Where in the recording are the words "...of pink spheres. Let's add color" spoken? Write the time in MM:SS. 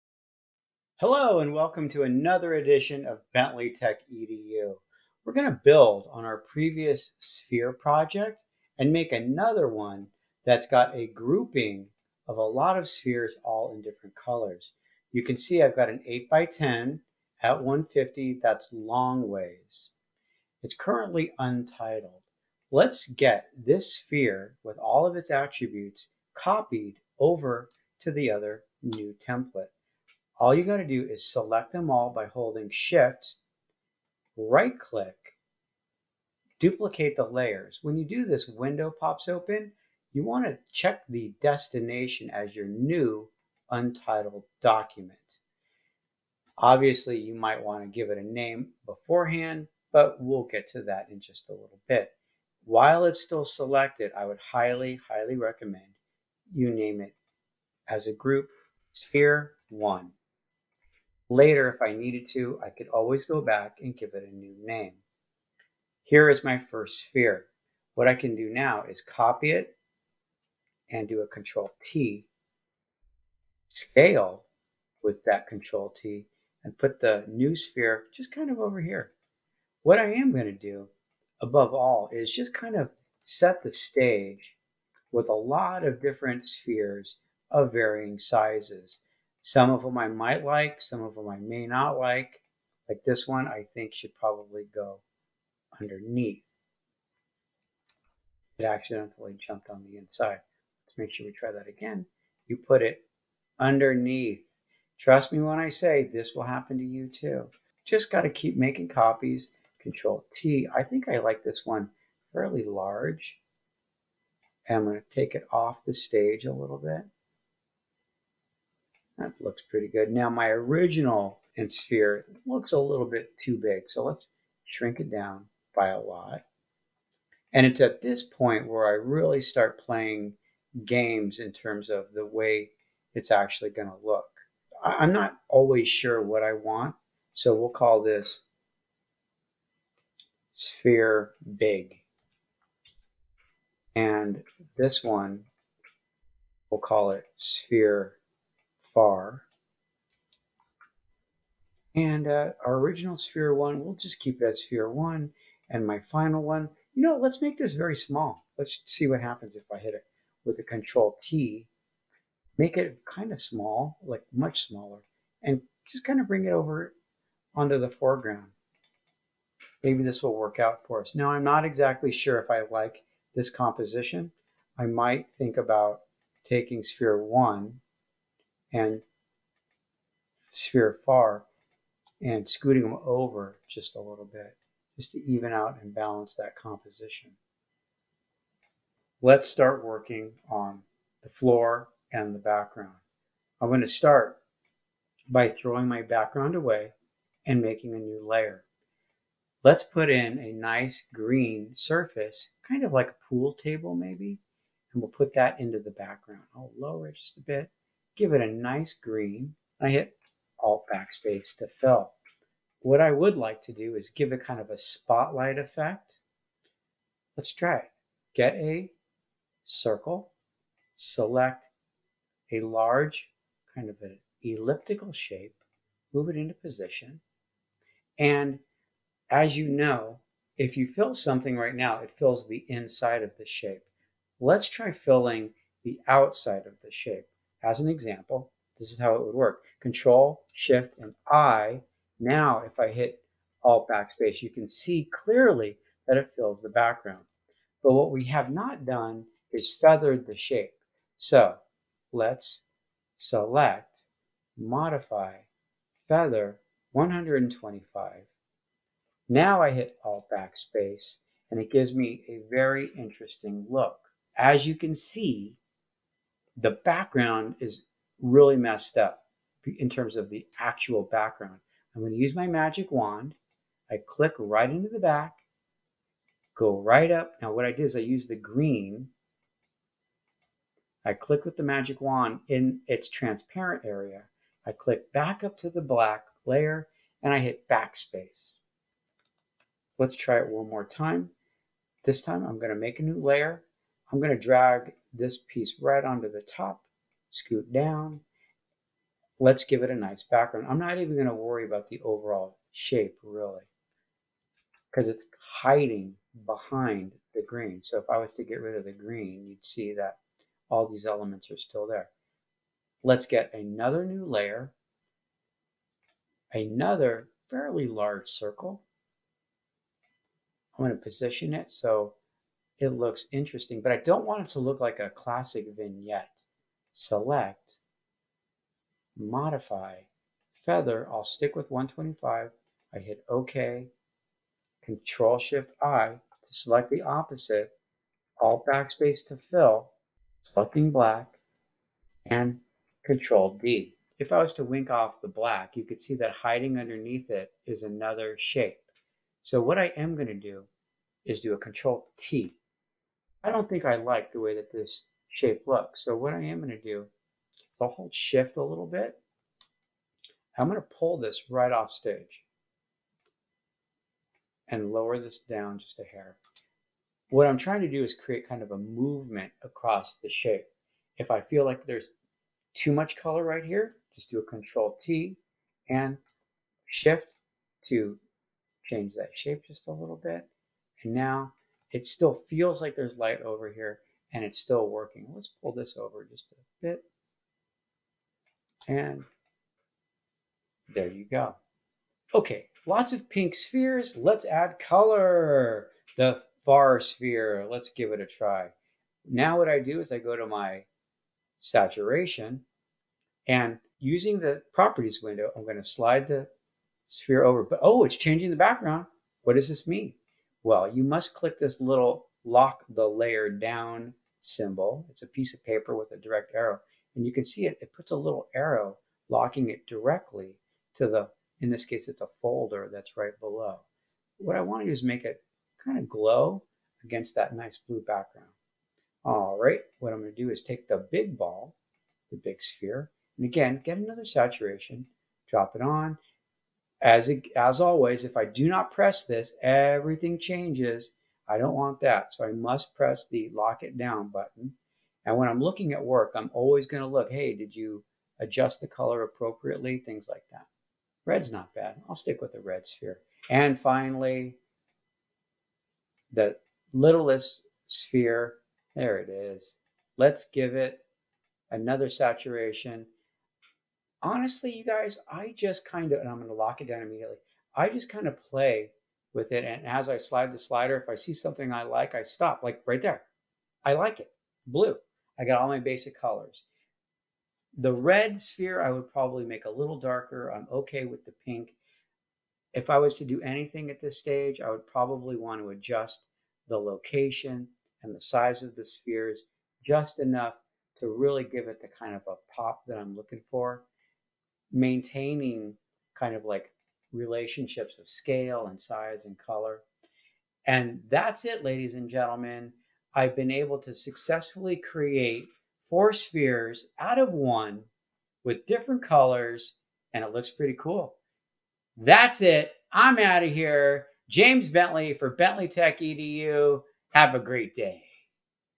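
06:33.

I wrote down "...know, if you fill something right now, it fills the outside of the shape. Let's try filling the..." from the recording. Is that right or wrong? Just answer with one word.
wrong.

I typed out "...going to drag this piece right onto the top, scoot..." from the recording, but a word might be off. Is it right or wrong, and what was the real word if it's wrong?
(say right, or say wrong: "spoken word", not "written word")
right.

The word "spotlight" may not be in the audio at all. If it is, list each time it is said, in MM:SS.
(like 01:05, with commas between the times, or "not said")
03:34.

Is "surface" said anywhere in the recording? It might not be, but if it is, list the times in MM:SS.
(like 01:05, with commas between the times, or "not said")
03:21.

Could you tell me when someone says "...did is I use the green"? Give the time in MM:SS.
04:37.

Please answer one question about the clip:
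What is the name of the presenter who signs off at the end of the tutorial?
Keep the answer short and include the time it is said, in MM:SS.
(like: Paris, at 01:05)
James Bentley, at 08:34.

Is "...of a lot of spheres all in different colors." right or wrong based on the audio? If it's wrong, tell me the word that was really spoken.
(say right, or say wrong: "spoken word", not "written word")
right.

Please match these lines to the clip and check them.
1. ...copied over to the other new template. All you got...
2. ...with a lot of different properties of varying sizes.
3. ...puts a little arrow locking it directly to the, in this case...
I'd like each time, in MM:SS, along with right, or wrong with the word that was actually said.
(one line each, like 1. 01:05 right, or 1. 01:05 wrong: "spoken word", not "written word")
1. 00:26 right
2. 01:25 wrong: "spheres", not "properties"
3. 06:57 right.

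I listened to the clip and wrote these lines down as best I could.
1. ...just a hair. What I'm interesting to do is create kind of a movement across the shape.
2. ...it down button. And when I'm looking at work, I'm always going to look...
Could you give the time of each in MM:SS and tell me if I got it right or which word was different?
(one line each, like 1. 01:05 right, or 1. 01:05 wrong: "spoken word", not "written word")
1. 06:05 wrong: "trying", not "interesting"
2. 07:23 right.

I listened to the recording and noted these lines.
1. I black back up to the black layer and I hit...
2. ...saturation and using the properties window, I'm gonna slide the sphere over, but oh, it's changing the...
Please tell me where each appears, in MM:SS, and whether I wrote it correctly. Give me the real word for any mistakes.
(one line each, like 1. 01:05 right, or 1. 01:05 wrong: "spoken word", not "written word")
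1. 04:44 wrong: "click", not "black"
2. 06:41 right.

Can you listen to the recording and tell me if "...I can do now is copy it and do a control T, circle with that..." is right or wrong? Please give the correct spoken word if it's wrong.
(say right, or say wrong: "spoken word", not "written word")
wrong: "scale", not "circle".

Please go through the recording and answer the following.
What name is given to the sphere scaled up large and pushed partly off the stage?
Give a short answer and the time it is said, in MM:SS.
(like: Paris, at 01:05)
sphere big, at 02:20.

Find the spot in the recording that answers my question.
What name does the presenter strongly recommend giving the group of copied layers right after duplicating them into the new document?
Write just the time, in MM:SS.
00:58.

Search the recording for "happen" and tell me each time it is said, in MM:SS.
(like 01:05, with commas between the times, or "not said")
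01:46, 02:39.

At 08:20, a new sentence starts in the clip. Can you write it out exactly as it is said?
And that's it, ladies and gentlemen.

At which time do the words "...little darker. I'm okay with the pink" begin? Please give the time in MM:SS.
07:59.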